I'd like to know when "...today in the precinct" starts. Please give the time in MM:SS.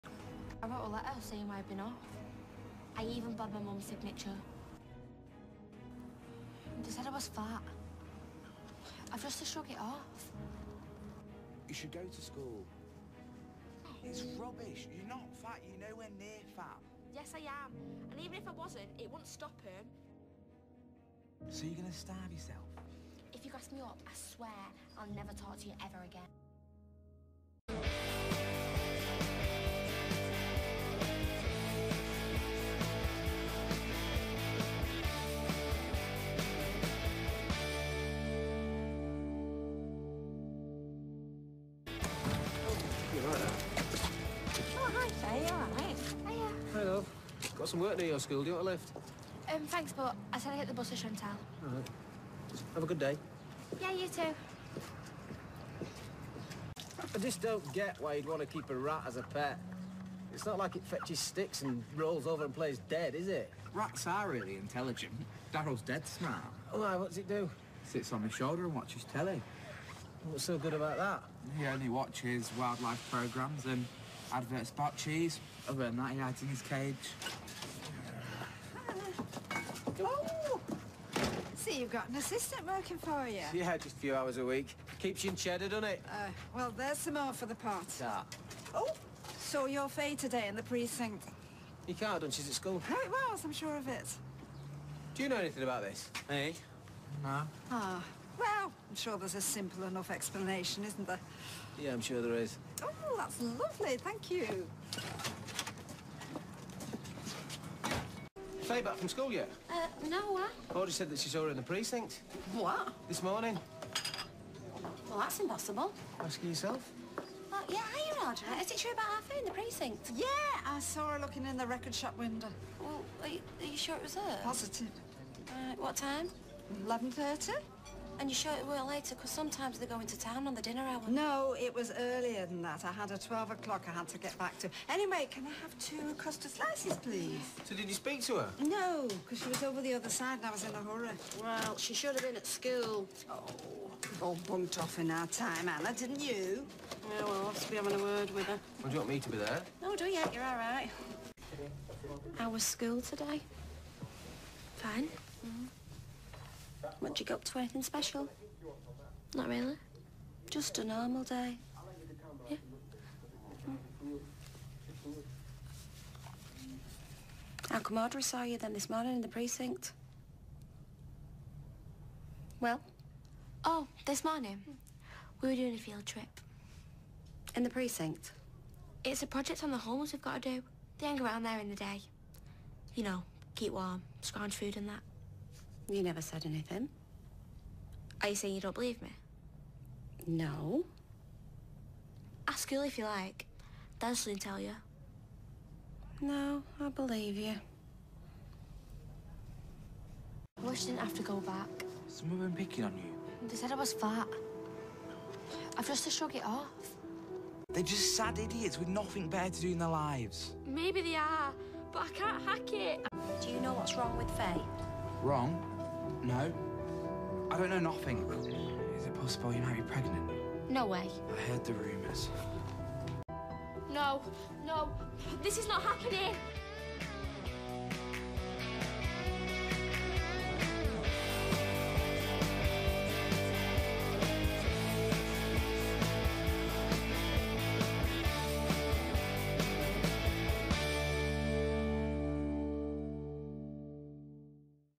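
01:30.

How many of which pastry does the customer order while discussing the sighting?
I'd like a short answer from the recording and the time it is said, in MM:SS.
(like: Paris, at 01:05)
2 custard slices, at 02:15.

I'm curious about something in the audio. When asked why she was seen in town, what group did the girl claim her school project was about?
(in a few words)
The homeless.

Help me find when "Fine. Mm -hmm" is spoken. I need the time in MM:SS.
02:34.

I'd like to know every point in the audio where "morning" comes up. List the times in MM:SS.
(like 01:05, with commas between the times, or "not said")
01:53, 02:48, 02:54.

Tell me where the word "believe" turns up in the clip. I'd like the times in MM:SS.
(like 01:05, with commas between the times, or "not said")
03:08, 03:16.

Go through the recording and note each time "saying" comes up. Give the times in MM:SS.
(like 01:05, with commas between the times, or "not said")
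00:01, 03:08.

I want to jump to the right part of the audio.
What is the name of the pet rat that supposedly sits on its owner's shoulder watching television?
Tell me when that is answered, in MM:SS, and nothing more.
01:05.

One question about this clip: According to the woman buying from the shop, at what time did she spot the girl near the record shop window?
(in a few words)
11:30.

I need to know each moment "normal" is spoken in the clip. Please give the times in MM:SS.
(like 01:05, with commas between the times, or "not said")
02:40.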